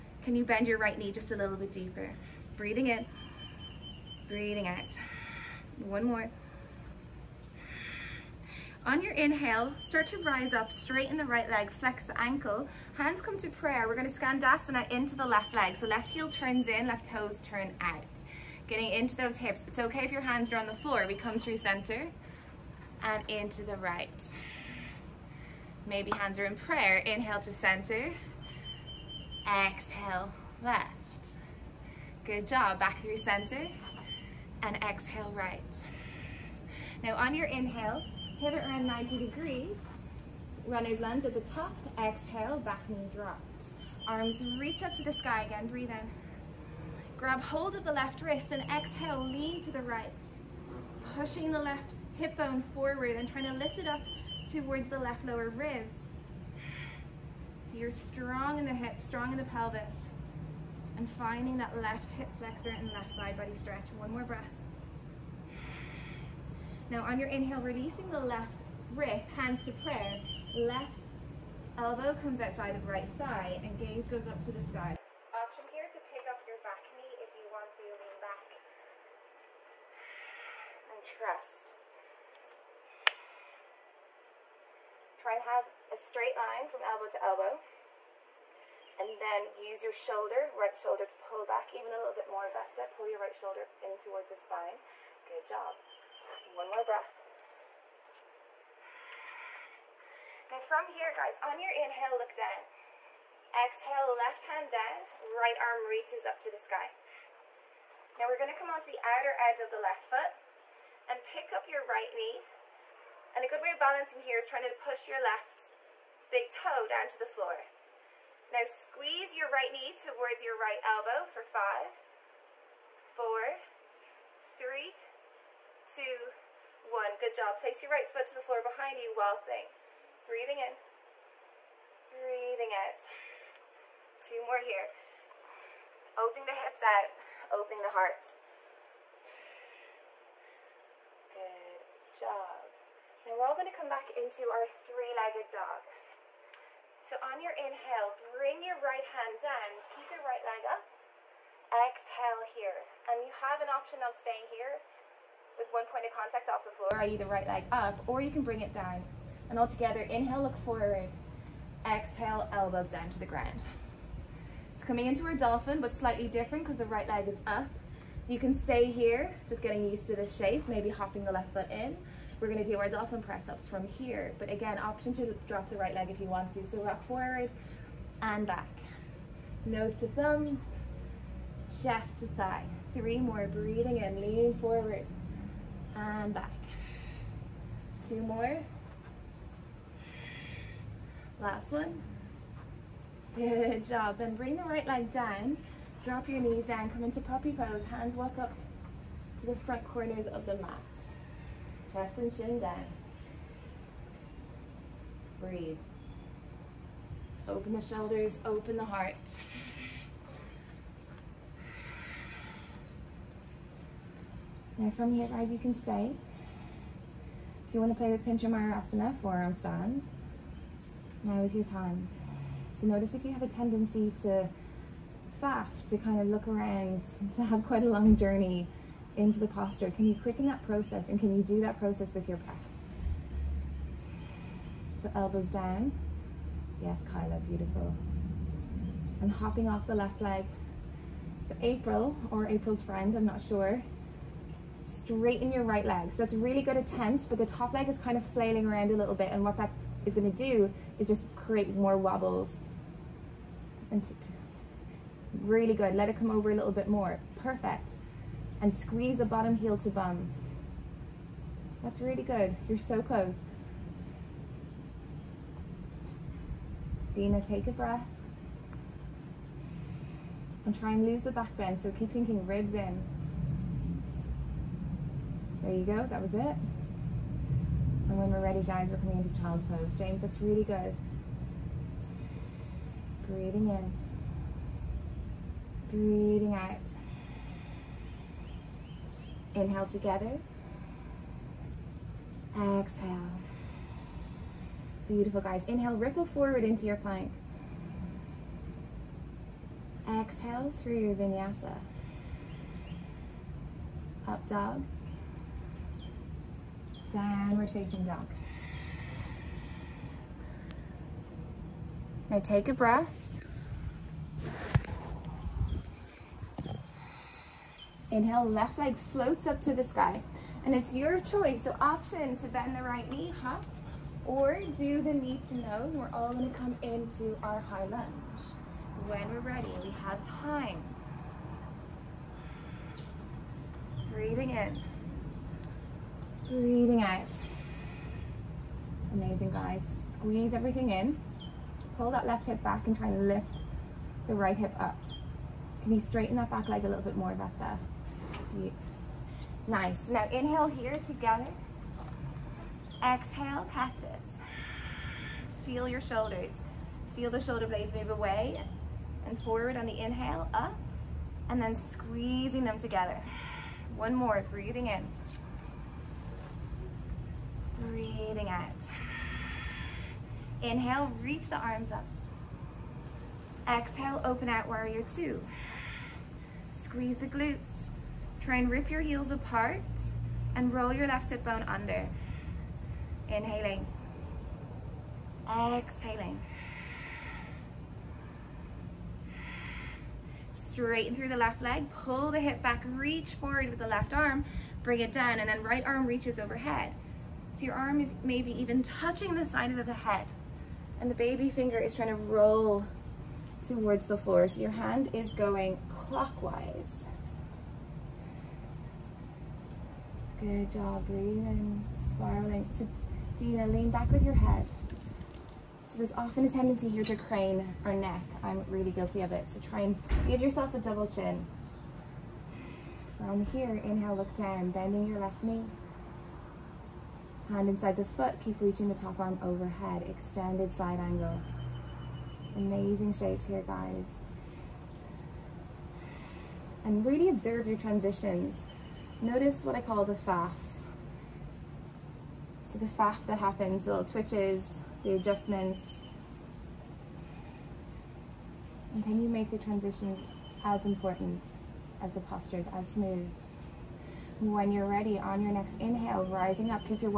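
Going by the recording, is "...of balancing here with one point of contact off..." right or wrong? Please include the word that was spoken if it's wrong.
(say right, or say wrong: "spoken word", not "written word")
wrong: "staying", not "balancing".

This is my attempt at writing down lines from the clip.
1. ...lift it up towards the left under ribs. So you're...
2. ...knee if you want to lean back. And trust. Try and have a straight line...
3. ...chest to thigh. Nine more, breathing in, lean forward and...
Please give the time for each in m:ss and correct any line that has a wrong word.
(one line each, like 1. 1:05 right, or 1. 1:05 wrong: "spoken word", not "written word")
1. 0:53 wrong: "lower", not "under"
2. 1:16 right
3. 3:01 wrong: "Three", not "Nine".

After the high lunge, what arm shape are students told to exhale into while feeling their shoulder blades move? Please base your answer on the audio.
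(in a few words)
Cactus.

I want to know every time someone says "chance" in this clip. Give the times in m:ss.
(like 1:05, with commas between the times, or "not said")
not said.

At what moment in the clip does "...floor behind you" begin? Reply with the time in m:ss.
2:08.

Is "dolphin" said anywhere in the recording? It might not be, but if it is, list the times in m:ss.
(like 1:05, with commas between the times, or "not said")
2:45, 2:52.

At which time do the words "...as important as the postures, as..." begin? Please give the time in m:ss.
7:30.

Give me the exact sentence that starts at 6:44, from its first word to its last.
So your hand is going clockwise.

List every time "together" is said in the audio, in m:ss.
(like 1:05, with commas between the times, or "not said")
2:39, 4:49, 5:51, 6:02.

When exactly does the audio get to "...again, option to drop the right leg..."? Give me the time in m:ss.
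2:54.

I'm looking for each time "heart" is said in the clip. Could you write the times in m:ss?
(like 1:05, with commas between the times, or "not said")
2:17, 3:28.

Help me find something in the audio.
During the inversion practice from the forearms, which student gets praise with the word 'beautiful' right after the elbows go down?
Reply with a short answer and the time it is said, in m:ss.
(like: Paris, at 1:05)
Kyla, at 3:57.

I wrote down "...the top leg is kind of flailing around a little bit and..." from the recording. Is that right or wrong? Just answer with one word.
right.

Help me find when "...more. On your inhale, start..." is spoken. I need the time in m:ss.
0:06.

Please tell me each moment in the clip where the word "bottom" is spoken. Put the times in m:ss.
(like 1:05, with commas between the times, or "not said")
4:19.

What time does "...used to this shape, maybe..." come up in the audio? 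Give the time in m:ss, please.
2:49.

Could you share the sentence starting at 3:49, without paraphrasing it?
Can you quicken that process and can you do that process with your breath?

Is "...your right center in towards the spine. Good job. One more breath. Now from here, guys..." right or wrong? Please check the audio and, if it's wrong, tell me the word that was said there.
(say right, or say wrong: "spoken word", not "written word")
wrong: "shoulder", not "center".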